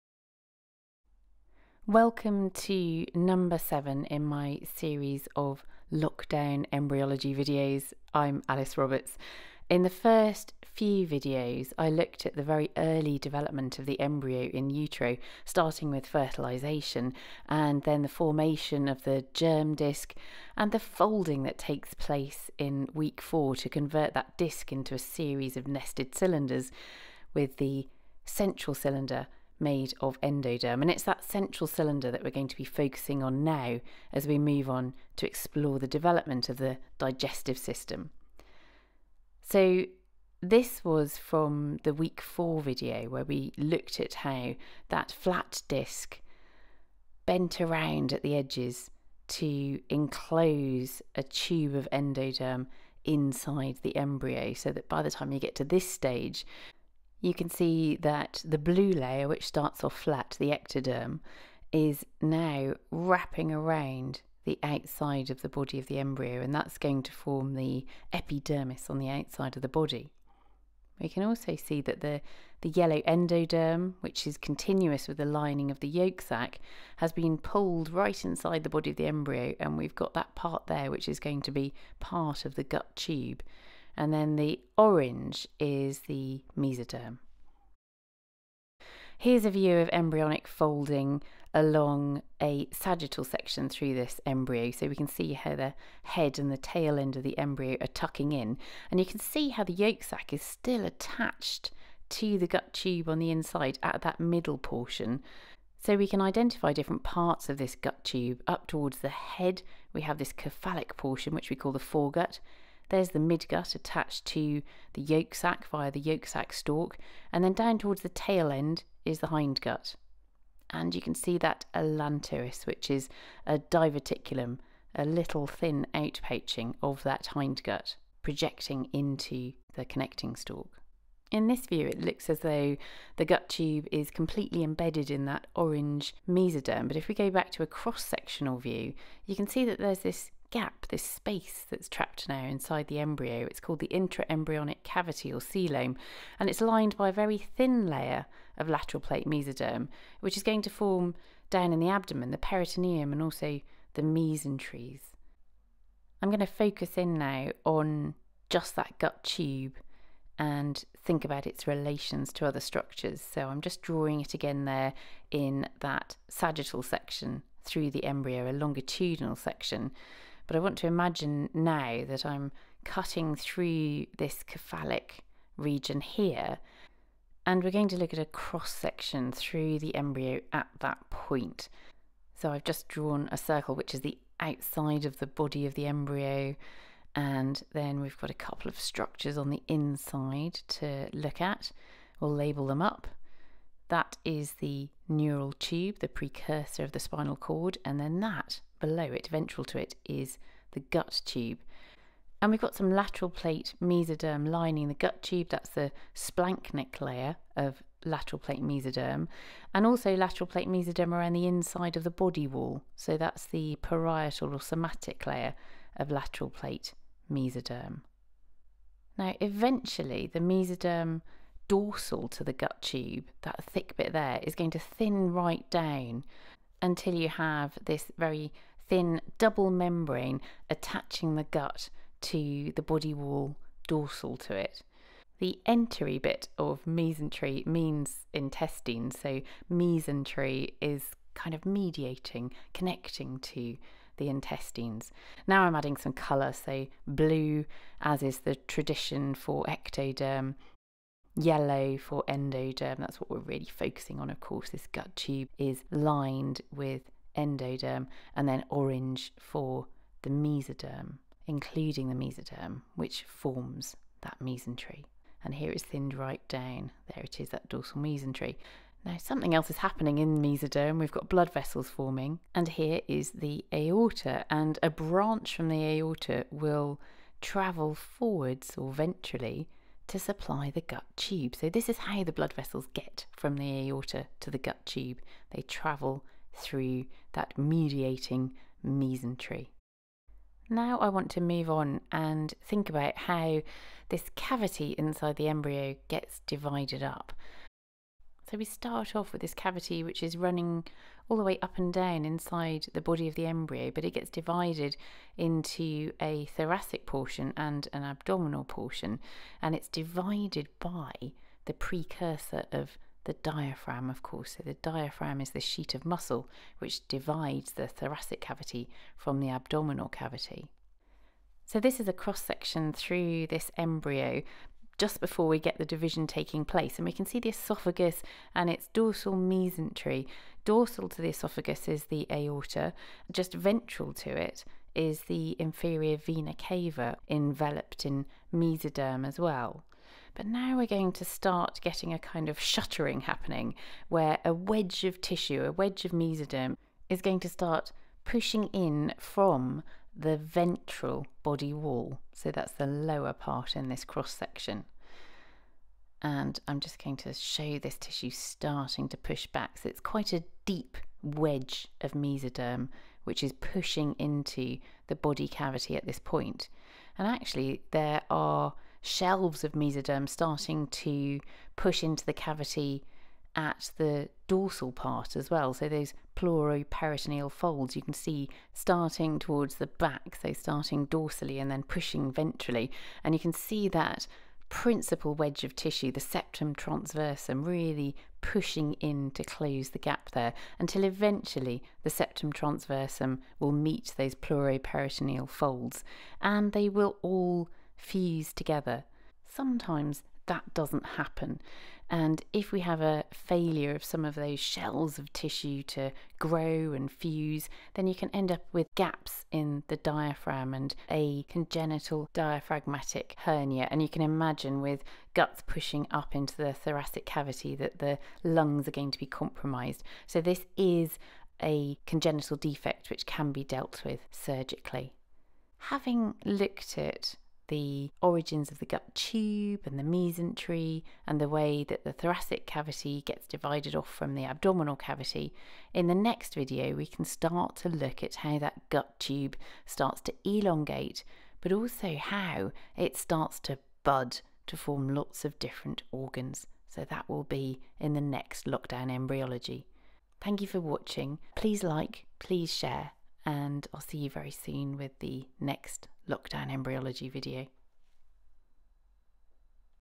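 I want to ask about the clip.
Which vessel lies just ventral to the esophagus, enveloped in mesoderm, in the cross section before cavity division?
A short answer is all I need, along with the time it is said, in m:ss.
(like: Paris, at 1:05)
Inferior vena cava, at 5:35.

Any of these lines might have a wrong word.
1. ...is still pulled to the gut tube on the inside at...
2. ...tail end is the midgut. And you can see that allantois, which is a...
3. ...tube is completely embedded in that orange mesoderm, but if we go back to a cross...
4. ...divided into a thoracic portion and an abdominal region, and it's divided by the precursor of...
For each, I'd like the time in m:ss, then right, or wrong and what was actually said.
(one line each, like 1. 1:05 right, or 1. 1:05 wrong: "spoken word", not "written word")
1. 1:40 wrong: "attached", not "pulled"
2. 1:58 wrong: "hindgut", not "midgut"
3. 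2:13 right
4. 5:04 wrong: "portion", not "region".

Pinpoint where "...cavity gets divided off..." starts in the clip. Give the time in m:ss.
7:12.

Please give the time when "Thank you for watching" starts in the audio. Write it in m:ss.
7:30.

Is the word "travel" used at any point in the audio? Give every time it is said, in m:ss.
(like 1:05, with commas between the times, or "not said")
4:37, 4:45.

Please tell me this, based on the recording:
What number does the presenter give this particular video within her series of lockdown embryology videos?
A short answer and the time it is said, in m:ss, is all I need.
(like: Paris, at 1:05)
7, at 0:03.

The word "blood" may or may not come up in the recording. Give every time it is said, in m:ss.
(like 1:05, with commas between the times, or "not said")
4:31, 4:42.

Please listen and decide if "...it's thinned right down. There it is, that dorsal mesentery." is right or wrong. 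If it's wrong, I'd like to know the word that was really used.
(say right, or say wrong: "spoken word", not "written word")
right.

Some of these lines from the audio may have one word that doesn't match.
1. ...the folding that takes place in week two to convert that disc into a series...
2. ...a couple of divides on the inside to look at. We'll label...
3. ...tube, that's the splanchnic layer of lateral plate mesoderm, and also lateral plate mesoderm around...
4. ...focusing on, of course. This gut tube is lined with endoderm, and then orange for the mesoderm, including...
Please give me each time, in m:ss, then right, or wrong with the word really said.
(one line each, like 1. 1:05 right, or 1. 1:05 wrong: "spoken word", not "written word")
1. 0:20 wrong: "four", not "two"
2. 3:08 wrong: "structures", not "divides"
3. 3:25 right
4. 4:13 right.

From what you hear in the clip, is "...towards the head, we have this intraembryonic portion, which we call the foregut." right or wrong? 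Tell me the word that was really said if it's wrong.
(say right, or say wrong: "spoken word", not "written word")
wrong: "cephalic", not "intraembryonic".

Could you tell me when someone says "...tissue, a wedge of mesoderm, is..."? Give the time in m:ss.
5:45.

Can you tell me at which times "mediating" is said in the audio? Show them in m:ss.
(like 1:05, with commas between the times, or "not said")
4:01, 4:47.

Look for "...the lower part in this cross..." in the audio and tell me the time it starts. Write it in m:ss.
5:52.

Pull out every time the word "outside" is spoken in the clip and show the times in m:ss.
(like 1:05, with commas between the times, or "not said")
1:04, 1:09, 3:04.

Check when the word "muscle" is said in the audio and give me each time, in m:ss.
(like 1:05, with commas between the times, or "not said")
5:16.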